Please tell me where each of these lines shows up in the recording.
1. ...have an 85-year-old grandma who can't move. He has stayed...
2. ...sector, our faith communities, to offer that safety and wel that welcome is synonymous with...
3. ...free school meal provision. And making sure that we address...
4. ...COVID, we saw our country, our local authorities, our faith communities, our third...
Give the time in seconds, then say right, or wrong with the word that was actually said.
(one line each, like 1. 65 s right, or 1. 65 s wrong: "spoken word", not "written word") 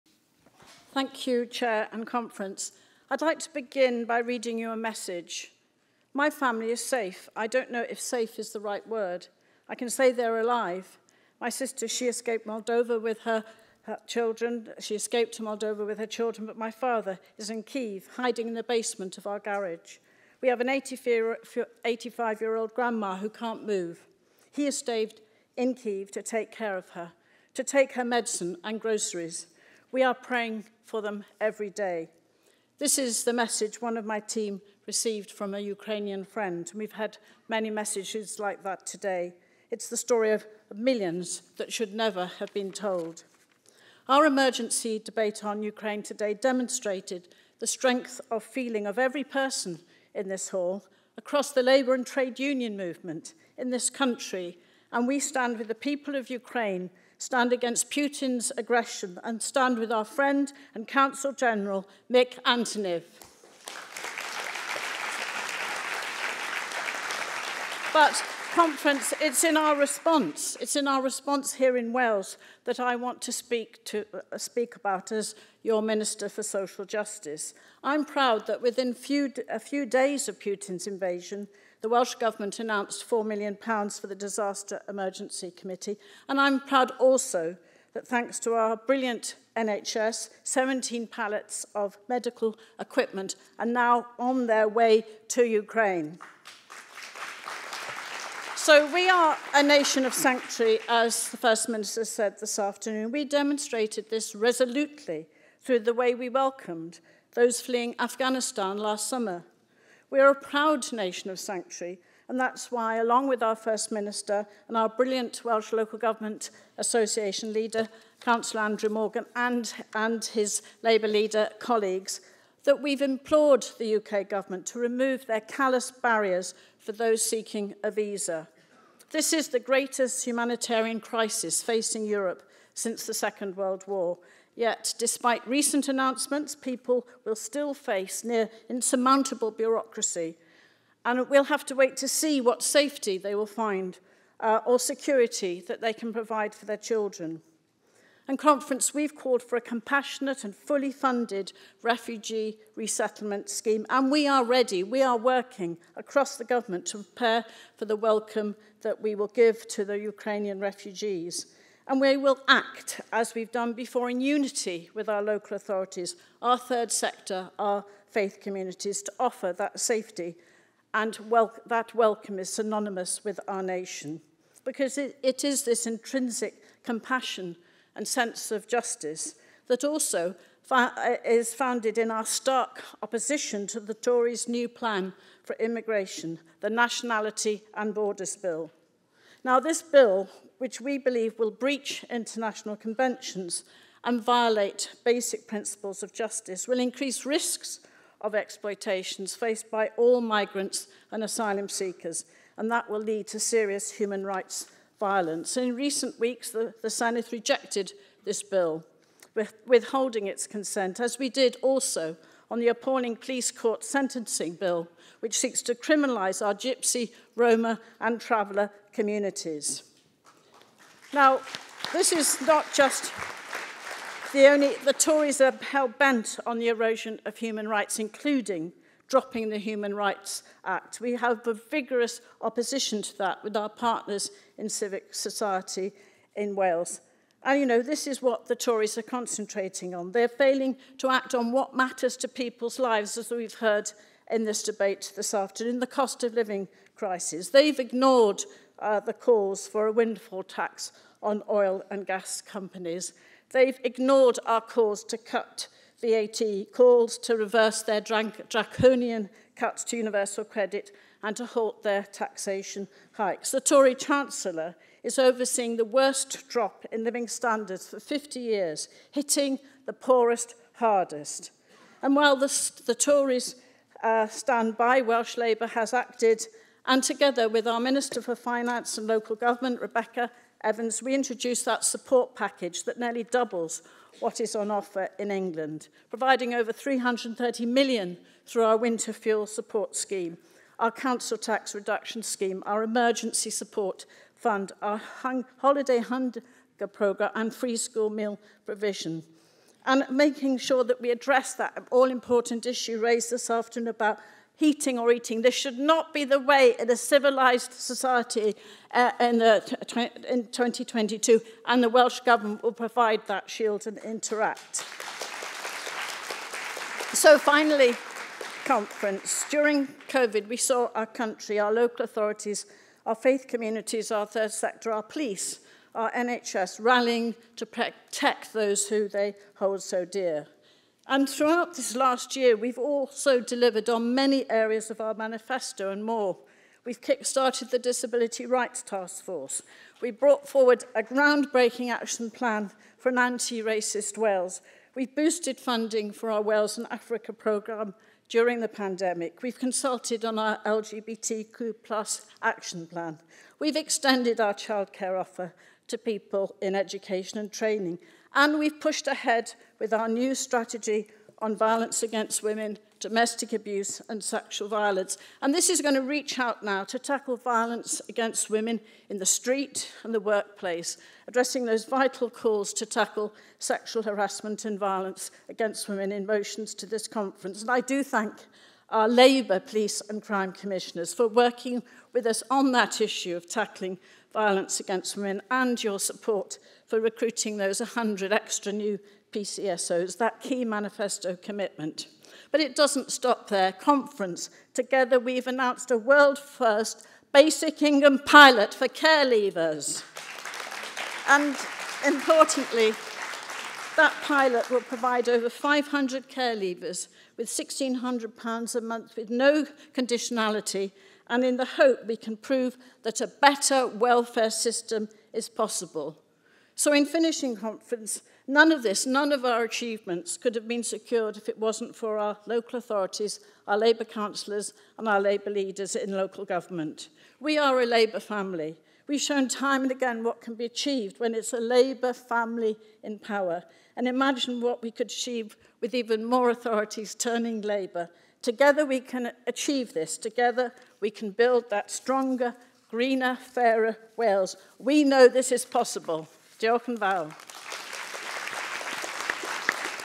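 1. 20 s right
2. 166 s right
3. 297 s right
4. 320 s right.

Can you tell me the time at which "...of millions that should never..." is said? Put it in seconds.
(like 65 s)
40 s.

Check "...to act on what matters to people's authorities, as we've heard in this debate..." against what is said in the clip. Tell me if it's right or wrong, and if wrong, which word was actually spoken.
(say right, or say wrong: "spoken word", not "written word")
wrong: "lives", not "authorities".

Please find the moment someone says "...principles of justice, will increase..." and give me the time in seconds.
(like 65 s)
195 s.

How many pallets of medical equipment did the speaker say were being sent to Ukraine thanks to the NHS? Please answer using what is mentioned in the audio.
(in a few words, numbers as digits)
17.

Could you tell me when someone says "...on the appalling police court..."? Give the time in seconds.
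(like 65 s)
212 s.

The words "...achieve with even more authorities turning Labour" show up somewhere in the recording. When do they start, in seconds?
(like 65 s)
435 s.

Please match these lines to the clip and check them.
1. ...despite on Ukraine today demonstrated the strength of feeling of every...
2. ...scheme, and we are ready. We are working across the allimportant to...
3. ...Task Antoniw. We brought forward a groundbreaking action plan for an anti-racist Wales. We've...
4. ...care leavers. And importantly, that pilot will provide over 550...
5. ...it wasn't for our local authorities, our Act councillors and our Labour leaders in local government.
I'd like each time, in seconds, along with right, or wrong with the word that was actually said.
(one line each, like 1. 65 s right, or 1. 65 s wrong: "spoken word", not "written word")
1. 44 s wrong: "debate", not "despite"
2. 153 s wrong: "government", not "allimportant"
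3. 338 s wrong: "Force", not "Antoniw"
4. 398 s wrong: "500", not "550"
5. 421 s wrong: "Labour", not "Act".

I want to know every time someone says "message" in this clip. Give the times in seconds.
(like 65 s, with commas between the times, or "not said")
4 s, 33 s, 37 s.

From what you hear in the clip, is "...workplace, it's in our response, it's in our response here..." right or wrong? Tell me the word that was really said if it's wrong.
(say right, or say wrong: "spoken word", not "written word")
wrong: "conference", not "workplace".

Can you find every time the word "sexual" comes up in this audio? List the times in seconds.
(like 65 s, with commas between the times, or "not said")
364 s, 373 s.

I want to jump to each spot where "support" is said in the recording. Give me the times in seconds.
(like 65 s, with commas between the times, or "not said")
281 s, 289 s, 293 s, 385 s.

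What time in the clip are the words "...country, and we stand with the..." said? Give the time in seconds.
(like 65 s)
53 s.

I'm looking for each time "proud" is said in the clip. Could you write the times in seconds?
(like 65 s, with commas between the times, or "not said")
78 s, 86 s, 110 s.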